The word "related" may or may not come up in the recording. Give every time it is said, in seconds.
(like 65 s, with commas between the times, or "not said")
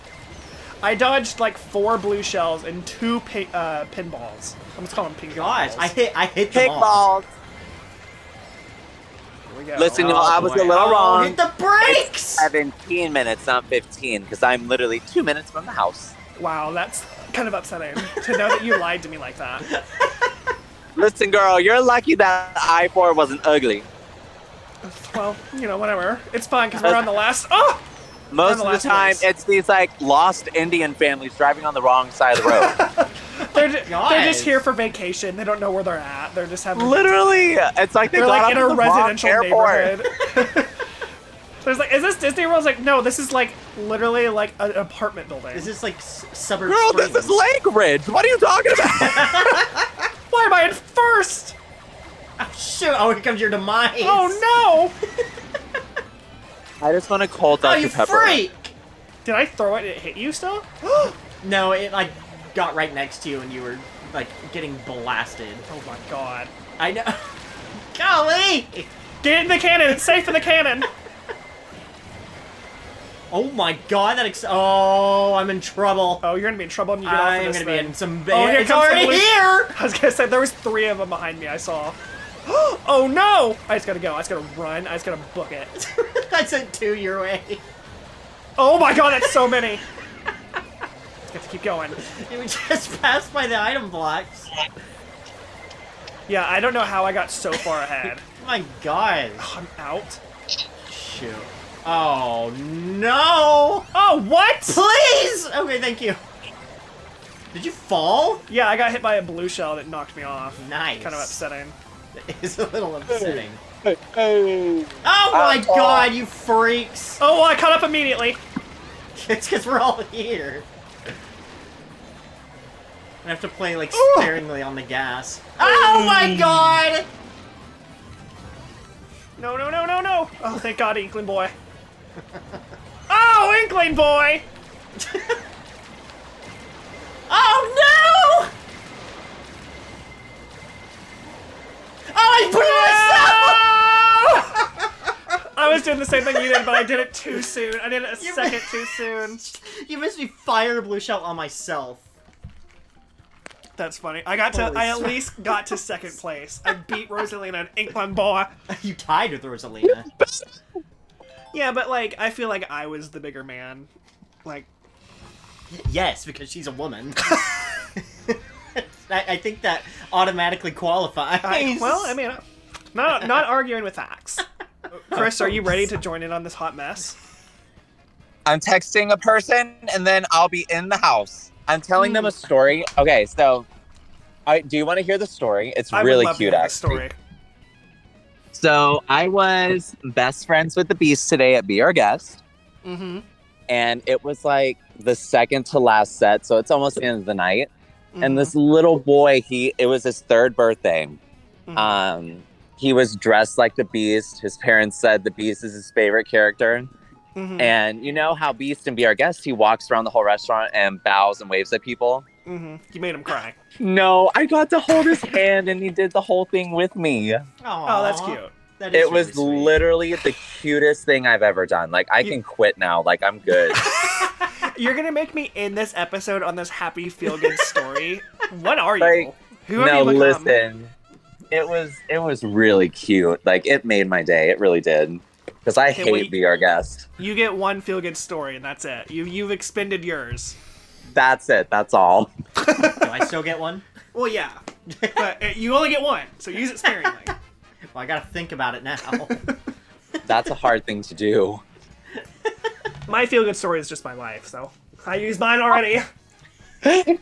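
not said.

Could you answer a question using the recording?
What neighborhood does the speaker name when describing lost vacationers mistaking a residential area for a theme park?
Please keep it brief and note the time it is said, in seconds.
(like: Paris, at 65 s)
Lake Ridge, at 47 s.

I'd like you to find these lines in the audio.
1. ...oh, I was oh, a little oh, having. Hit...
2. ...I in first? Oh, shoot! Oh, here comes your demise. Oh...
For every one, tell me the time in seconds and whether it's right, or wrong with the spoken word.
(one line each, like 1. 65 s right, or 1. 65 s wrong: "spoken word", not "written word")
1. 10 s wrong: "wrong", not "having"
2. 50 s right.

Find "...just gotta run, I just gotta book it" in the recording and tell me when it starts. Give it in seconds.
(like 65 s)
84 s.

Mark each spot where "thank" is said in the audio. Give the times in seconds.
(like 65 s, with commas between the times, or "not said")
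105 s, 130 s.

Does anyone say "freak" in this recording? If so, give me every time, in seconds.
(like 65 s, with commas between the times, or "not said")
58 s, 116 s.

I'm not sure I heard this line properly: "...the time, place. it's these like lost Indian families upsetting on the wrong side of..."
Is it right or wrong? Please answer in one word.
wrong.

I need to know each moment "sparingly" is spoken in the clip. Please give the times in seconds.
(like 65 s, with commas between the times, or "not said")
124 s, 246 s.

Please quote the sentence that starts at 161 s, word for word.
Yeah, but like I feel like I was the bigger man.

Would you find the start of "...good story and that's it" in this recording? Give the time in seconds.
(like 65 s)
238 s.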